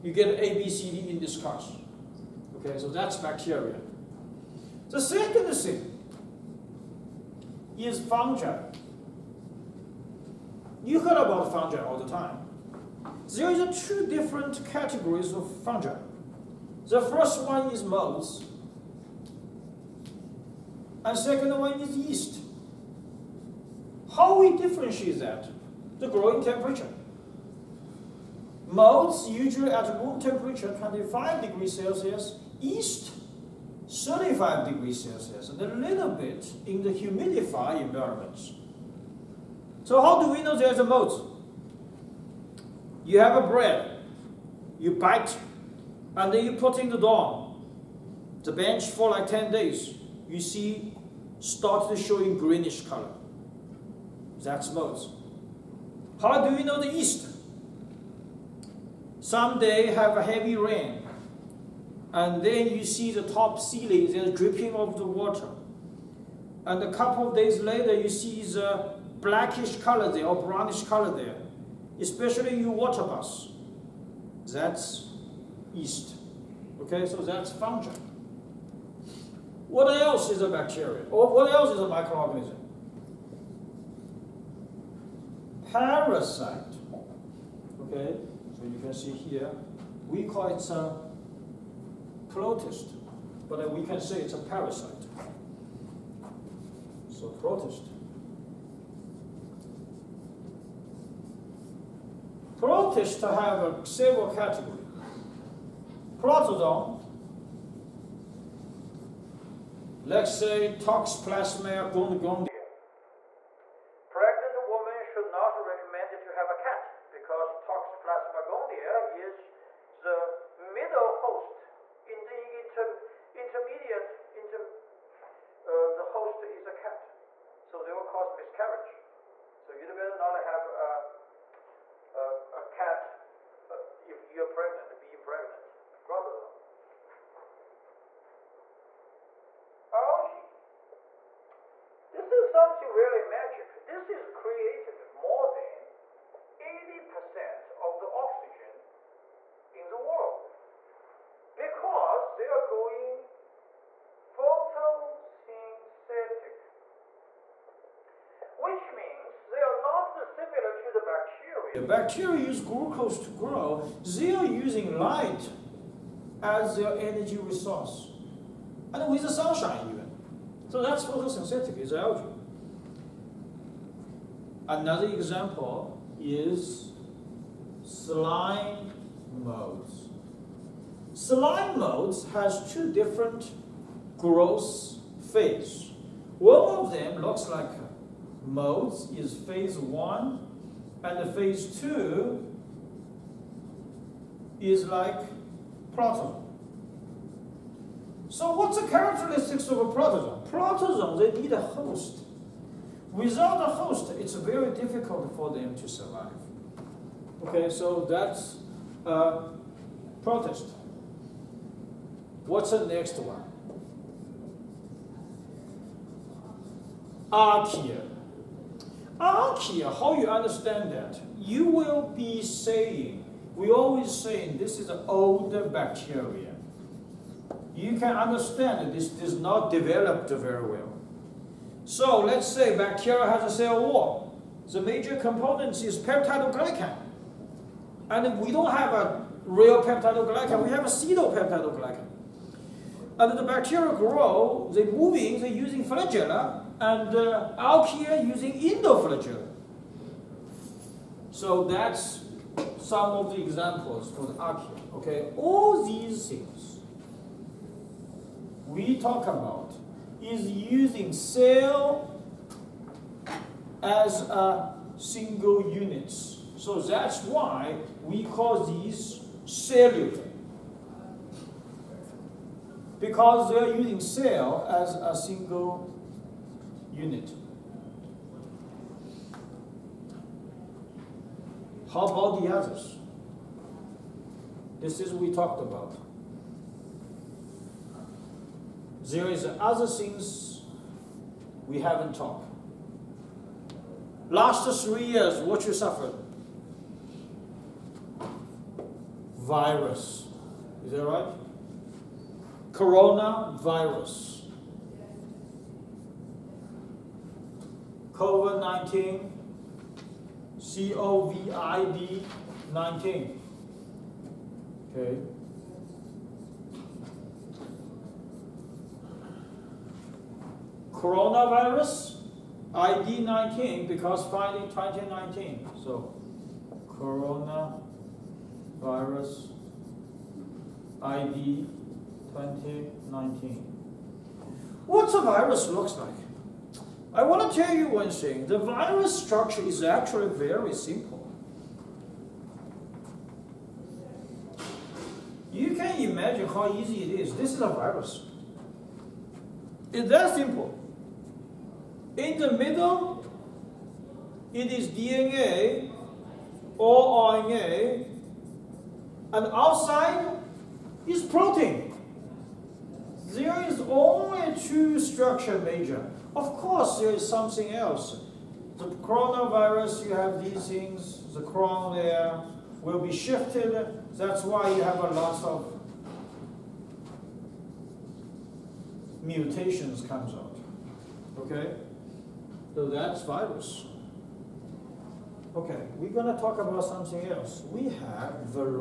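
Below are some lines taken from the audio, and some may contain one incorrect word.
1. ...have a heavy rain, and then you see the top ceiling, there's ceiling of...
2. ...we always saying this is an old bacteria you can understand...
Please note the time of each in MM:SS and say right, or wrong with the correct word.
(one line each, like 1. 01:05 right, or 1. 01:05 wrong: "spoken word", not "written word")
1. 00:59 wrong: "dripping", not "ceiling"
2. 03:43 right.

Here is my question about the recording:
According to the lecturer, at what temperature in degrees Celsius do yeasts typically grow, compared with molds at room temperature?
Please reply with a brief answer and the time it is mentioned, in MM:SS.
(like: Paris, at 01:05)
35 degrees Celsius, at 00:33.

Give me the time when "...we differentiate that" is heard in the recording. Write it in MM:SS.
00:24.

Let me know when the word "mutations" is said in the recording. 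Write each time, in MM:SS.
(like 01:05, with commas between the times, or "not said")
06:19.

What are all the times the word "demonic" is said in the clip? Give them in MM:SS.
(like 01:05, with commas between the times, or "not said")
not said.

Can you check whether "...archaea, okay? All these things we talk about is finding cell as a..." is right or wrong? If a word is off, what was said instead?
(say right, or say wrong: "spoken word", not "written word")
wrong: "using", not "finding".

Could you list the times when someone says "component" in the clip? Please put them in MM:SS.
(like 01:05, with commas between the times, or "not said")
03:55.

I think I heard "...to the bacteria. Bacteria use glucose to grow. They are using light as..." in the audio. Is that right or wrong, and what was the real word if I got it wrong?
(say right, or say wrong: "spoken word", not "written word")
right.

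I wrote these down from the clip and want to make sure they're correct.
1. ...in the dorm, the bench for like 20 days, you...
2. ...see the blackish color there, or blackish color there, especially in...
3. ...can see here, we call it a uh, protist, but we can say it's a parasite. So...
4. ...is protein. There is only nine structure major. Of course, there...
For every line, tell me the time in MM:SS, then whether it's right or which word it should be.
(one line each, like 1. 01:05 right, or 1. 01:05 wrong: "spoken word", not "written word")
1. 00:46 wrong: "10", not "20"
2. 01:08 wrong: "brownish", not "blackish"
3. 01:28 right
4. 06:01 wrong: "two", not "nine".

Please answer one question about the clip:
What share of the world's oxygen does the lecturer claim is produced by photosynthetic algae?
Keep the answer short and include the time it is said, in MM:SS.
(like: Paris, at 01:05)
more than 80%, at 02:25.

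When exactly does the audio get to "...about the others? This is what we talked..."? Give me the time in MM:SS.
04:42.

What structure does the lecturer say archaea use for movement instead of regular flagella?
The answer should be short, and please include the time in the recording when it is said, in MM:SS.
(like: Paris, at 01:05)
endoflagella, at 04:08.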